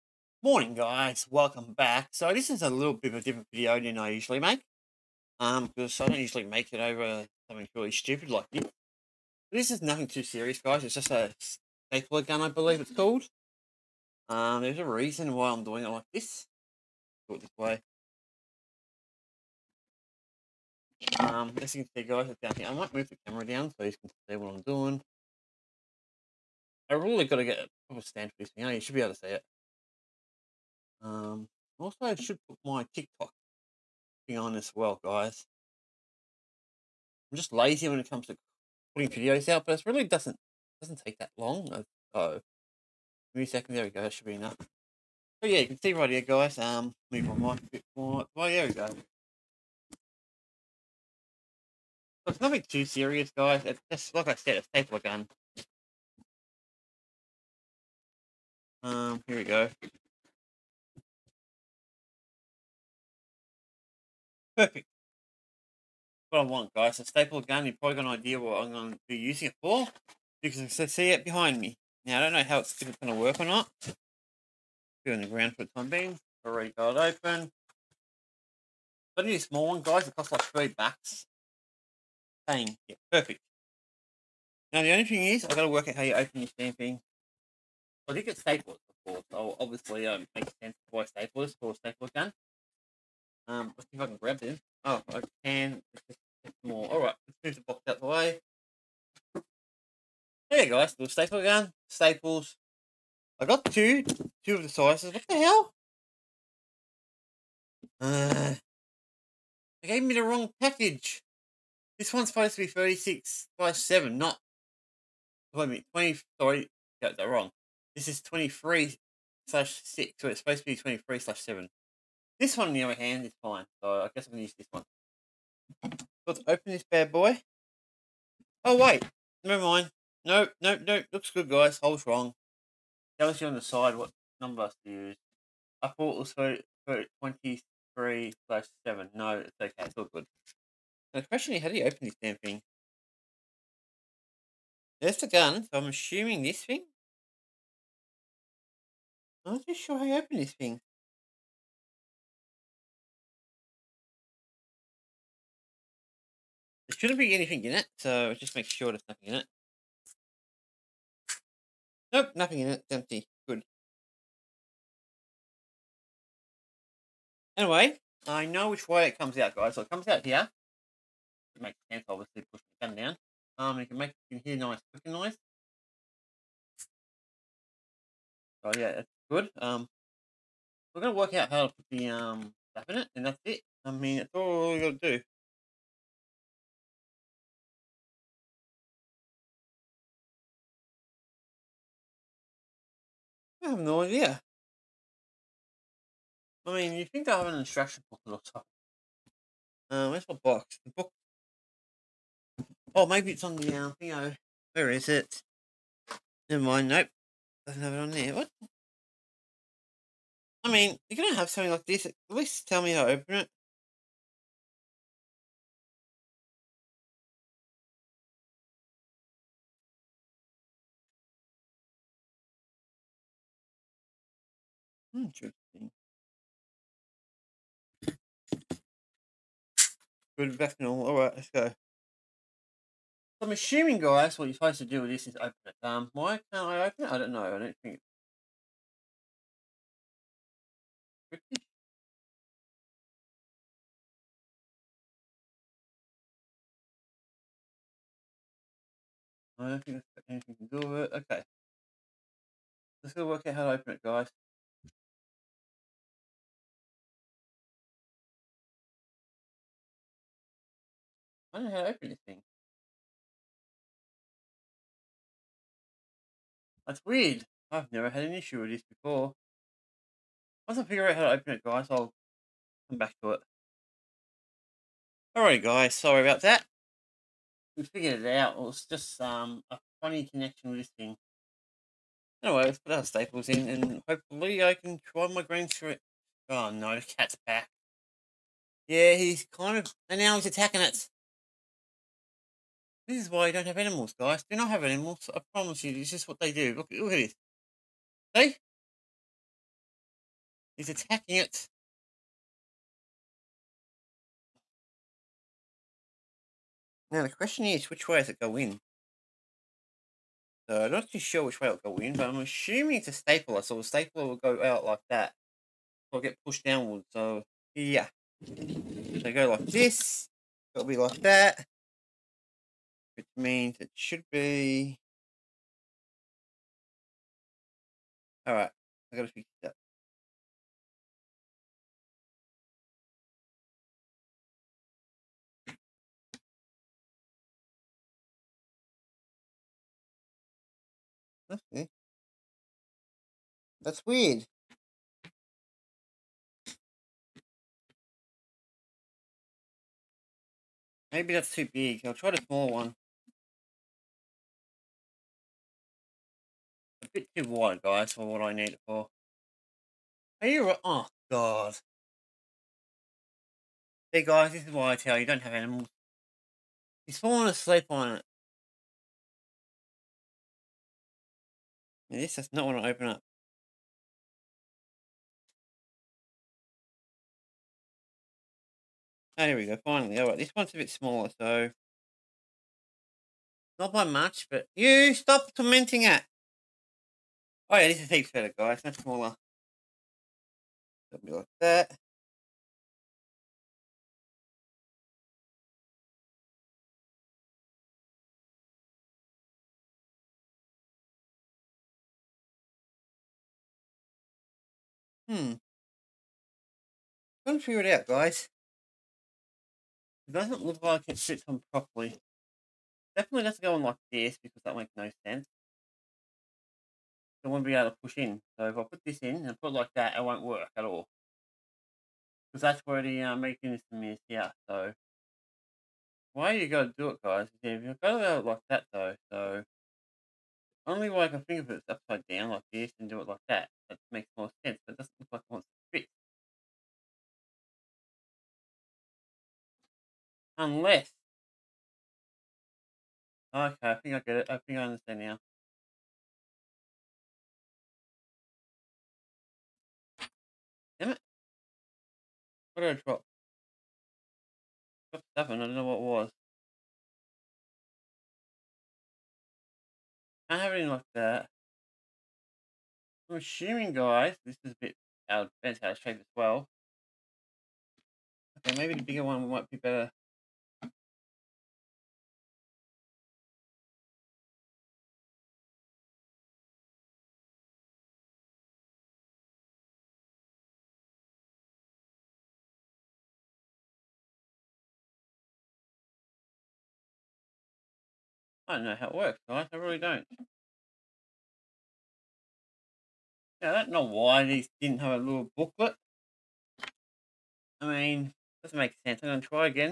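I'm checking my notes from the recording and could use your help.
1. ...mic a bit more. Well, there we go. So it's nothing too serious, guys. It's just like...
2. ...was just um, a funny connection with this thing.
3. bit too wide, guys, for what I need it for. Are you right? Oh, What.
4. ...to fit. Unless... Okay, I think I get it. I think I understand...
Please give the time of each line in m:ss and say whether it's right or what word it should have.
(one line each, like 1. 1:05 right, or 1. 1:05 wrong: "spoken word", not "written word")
1. 0:47 right
2. 4:38 right
3. 5:57 wrong: "God", not "What"
4. 7:15 right.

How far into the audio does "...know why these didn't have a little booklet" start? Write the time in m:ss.
8:13.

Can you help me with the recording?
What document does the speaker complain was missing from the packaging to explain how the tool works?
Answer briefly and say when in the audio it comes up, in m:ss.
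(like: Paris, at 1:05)
instruction book, at 3:17.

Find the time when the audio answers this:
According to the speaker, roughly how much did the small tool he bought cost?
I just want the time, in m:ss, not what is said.
1:20.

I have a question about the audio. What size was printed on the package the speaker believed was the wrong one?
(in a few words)
23/6.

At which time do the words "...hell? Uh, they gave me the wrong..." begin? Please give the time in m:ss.
1:45.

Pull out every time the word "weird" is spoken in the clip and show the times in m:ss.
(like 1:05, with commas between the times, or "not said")
4:27, 5:44.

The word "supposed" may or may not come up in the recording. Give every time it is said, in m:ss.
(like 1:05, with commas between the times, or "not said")
1:52, 2:00, 3:54.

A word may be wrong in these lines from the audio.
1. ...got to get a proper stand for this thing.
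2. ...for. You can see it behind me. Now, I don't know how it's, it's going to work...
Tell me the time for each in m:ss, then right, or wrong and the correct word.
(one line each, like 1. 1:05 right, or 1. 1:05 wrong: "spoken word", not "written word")
1. 0:27 right
2. 1:09 right.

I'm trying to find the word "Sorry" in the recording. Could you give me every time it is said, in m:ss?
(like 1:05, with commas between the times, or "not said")
1:56, 4:35.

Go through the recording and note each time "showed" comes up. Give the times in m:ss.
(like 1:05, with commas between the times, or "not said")
not said.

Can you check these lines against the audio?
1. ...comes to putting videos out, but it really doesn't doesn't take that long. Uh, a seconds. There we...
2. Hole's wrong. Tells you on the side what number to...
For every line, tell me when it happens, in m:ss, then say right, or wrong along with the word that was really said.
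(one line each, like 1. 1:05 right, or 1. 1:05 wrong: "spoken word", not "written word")
1. 0:38 right
2. 2:11 right.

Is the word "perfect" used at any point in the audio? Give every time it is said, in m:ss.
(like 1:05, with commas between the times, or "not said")
1:04, 1:23.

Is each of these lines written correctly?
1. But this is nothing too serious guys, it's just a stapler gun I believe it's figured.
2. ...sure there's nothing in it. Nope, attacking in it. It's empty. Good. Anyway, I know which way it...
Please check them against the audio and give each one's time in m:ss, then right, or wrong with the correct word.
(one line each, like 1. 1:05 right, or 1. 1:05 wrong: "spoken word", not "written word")
1. 0:08 wrong: "called", not "figured"
2. 2:38 wrong: "nothing", not "attacking".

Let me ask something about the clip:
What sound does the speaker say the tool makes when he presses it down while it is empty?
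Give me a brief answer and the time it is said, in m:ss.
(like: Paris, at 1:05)
clicking noise, at 2:54.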